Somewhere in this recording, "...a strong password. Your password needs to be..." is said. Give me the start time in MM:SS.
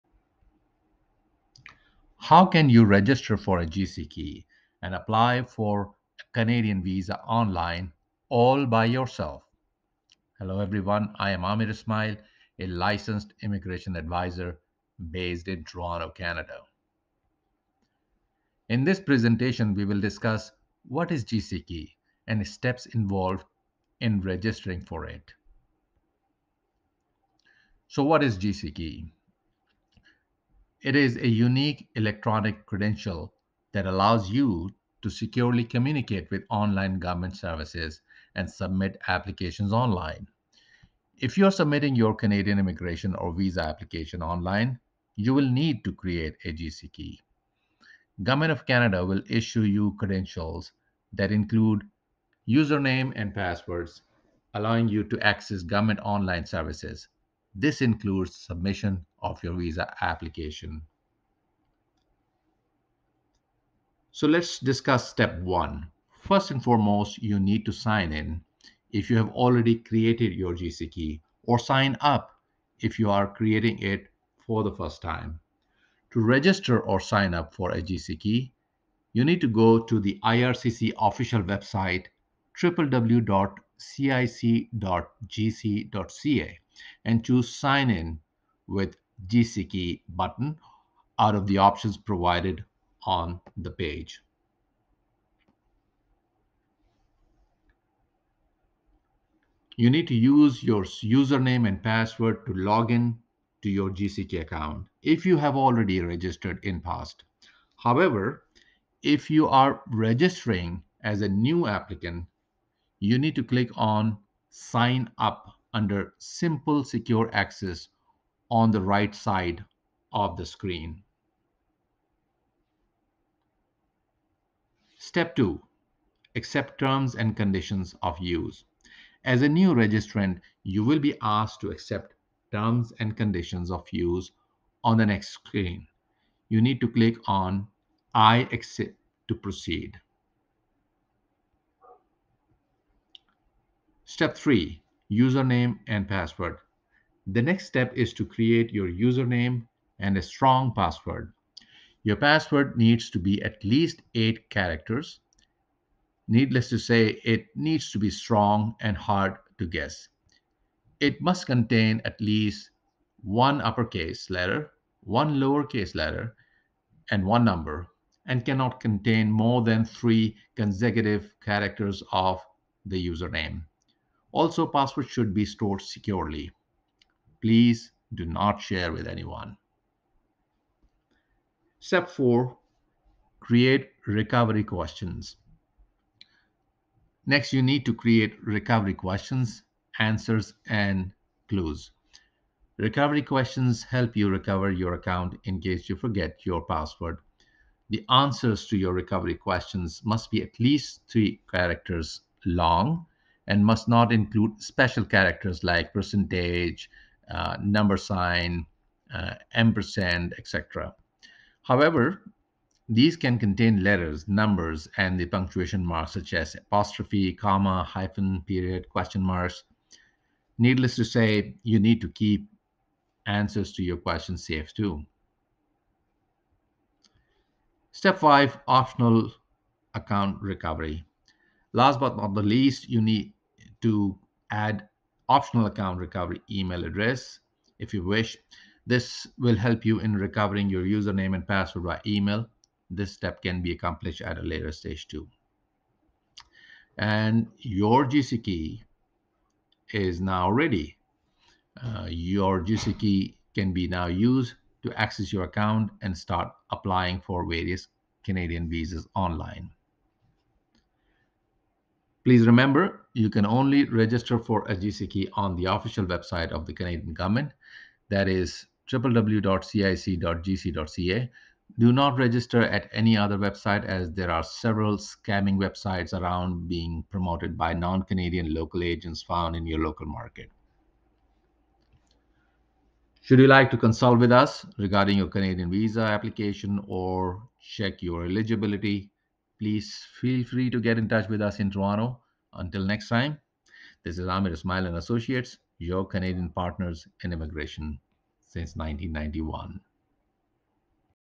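02:30.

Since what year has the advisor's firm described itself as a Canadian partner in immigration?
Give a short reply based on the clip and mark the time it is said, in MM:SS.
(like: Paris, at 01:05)
1991, at 04:58.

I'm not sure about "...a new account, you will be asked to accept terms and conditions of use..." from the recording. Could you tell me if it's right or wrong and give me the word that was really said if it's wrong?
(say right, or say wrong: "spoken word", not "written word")
wrong: "registrant", not "account".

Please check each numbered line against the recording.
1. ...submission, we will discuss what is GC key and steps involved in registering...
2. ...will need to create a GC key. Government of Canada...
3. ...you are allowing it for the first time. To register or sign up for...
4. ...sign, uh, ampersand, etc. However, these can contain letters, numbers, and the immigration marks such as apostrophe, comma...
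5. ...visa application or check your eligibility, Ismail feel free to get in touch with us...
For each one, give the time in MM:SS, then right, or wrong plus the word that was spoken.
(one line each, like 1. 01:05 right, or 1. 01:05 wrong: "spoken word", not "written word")
1. 00:18 wrong: "presentation", not "submission"
2. 00:45 right
3. 01:12 wrong: "creating", not "allowing"
4. 03:27 wrong: "punctuation", not "immigration"
5. 04:45 wrong: "Please", not "Ismail".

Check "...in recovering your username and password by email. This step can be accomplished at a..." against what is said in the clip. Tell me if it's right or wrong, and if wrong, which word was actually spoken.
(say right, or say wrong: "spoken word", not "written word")
right.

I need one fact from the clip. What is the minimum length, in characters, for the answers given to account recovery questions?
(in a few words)
3.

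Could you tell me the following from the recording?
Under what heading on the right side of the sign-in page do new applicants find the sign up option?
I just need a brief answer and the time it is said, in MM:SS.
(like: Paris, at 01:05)
Simple secure access, at 01:56.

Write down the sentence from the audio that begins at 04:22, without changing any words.
Please remember, you can only register for a GC key on the official website of the Canadian government.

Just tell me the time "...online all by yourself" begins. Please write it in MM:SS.
00:07.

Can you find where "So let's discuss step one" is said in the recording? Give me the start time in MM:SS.
01:04.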